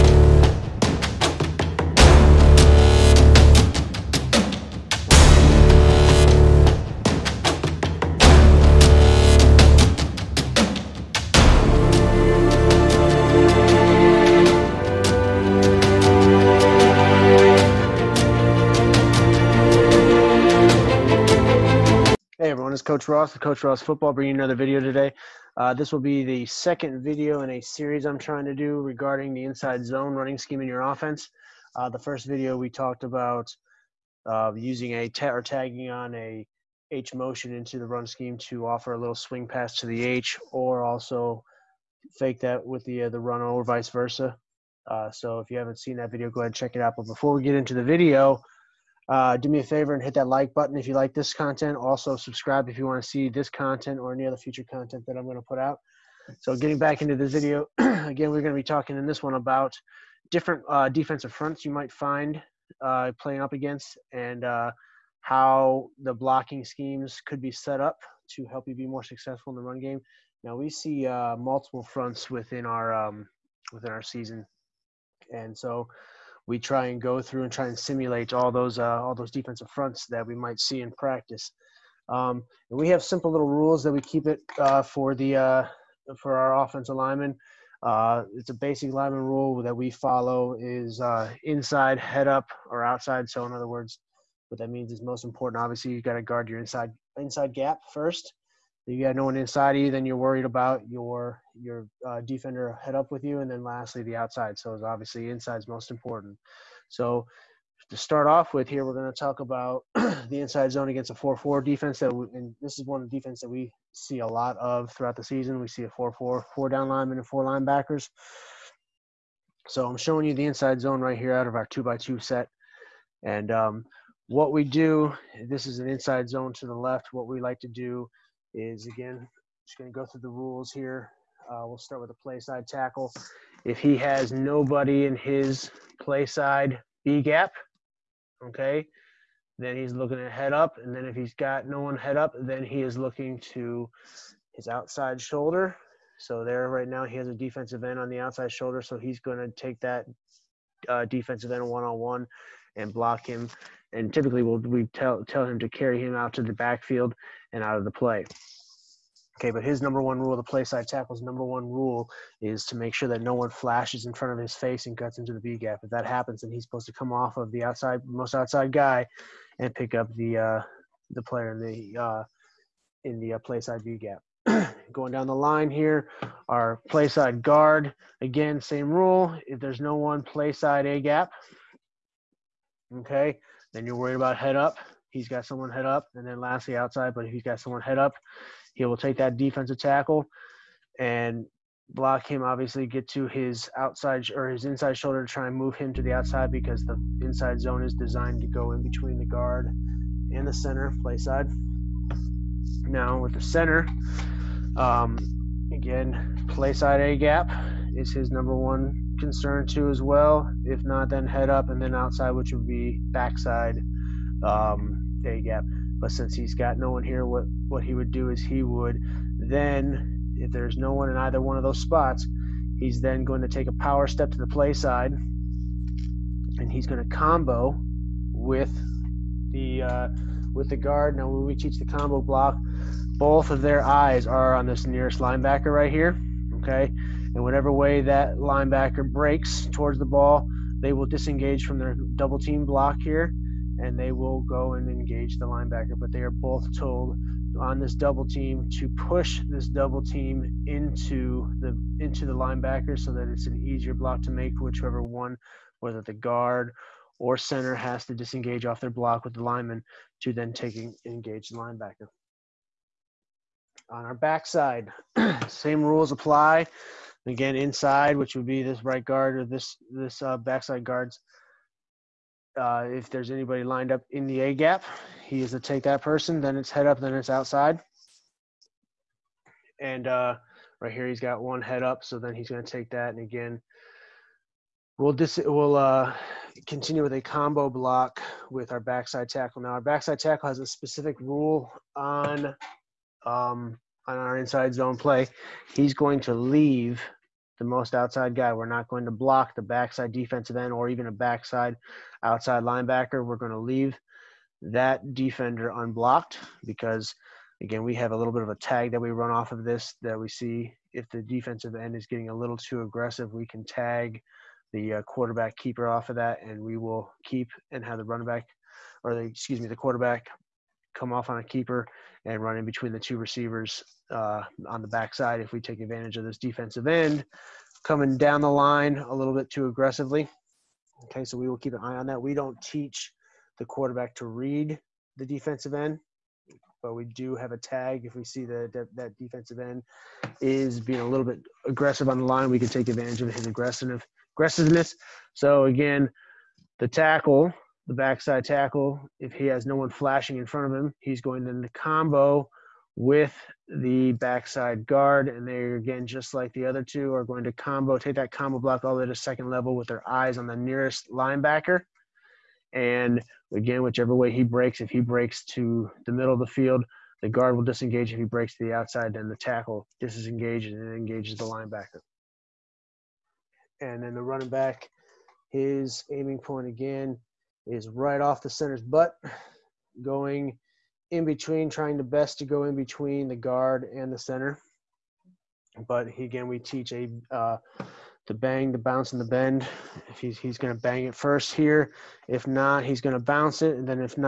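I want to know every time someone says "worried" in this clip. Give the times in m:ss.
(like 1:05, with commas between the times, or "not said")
1:40, 3:03.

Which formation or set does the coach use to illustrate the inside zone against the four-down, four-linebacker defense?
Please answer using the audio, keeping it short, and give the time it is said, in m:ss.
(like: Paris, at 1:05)
Two by two, at 2:01.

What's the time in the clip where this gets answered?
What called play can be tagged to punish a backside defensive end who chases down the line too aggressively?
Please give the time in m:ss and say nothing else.
5:15.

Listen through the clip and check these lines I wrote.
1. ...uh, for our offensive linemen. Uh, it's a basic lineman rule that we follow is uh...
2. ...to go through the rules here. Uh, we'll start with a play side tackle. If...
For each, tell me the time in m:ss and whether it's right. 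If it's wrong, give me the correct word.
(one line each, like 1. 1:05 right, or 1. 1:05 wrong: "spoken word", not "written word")
1. 1:25 right
2. 2:09 right.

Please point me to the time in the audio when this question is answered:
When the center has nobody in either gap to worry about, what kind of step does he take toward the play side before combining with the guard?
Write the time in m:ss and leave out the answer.
3:43.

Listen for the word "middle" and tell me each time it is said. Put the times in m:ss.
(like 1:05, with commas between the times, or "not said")
6:06.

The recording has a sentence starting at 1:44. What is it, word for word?
So it's obviously is most important.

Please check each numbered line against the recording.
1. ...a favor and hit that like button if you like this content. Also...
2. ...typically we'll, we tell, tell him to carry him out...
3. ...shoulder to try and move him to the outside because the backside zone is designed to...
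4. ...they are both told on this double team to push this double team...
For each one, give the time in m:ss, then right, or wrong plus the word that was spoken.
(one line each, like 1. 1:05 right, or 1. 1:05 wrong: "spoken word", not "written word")
1. 0:49 right
2. 2:34 right
3. 3:14 wrong: "inside", not "backside"
4. 4:06 right.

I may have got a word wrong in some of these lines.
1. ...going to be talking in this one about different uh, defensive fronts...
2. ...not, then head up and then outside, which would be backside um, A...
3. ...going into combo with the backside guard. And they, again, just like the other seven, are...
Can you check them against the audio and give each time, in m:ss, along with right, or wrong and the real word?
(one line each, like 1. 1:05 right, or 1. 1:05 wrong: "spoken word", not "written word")
1. 0:58 right
2. 3:30 right
3. 5:51 wrong: "two", not "seven".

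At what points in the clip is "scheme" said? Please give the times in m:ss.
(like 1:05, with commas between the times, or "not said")
0:30, 0:38, 1:06.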